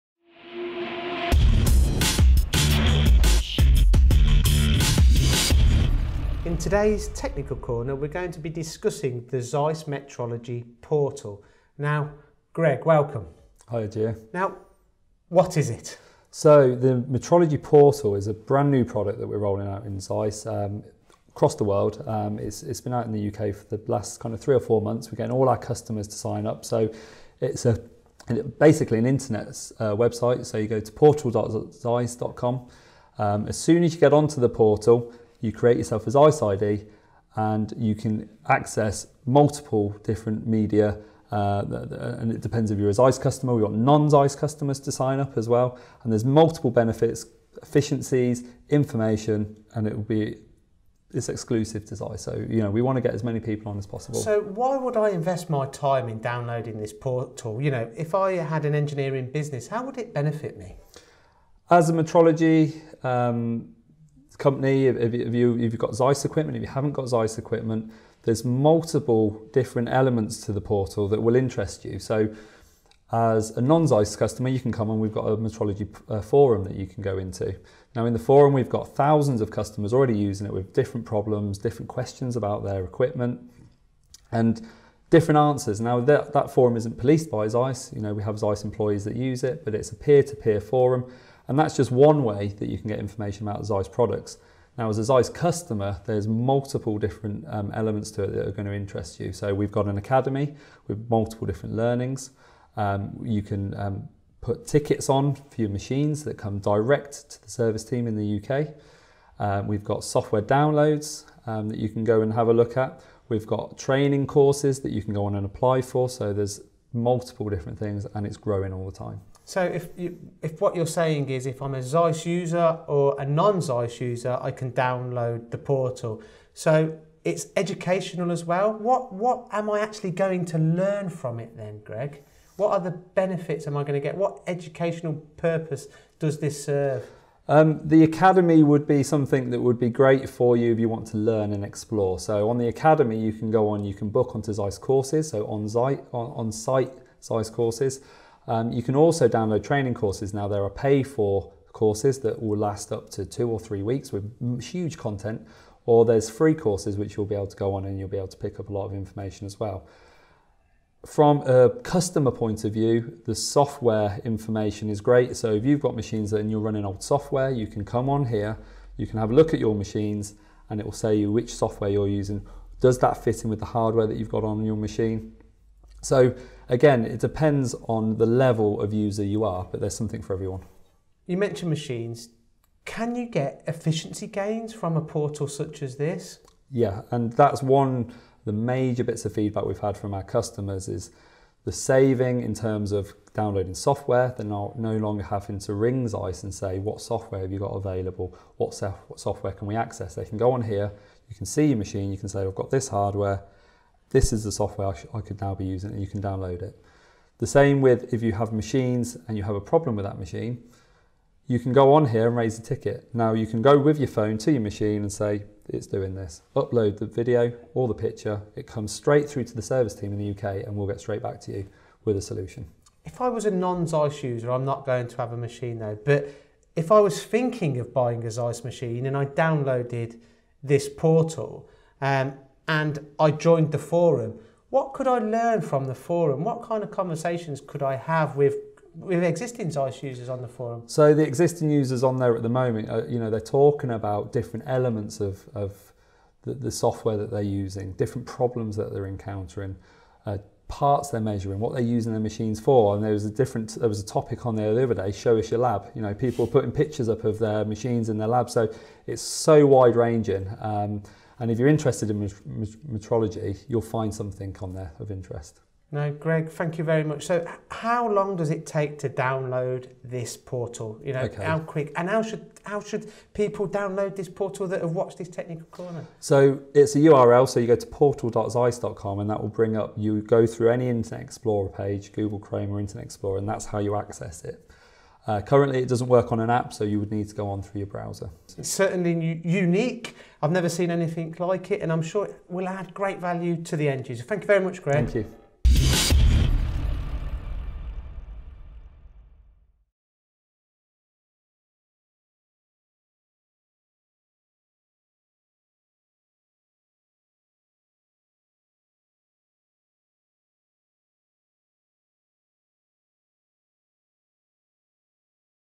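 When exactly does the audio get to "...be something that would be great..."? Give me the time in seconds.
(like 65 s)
138 s.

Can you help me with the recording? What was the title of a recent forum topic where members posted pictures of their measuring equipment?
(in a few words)
Show us your lab.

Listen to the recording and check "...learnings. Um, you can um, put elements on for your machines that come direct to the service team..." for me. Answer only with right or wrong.
wrong.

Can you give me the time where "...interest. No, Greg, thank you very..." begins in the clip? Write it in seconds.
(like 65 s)
265 s.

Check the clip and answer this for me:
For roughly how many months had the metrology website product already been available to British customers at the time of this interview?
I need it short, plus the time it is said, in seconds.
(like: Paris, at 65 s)
3 or 4 months, at 24 s.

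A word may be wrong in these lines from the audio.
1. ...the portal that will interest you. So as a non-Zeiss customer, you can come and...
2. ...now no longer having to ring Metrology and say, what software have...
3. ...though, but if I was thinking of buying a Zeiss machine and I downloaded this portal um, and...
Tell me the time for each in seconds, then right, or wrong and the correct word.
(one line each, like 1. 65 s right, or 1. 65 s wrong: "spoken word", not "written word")
1. 70 s right
2. 194 s wrong: "Zeiss", not "Metrology"
3. 225 s right.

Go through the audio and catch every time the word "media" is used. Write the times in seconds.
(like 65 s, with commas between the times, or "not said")
40 s.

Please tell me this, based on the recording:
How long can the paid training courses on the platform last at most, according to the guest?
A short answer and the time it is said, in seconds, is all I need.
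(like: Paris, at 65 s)
2 or 3 weeks, at 153 s.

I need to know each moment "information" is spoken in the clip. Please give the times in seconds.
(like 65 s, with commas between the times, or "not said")
48 s, 92 s, 158 s, 164 s.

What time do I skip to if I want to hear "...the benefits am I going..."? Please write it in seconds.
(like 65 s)
132 s.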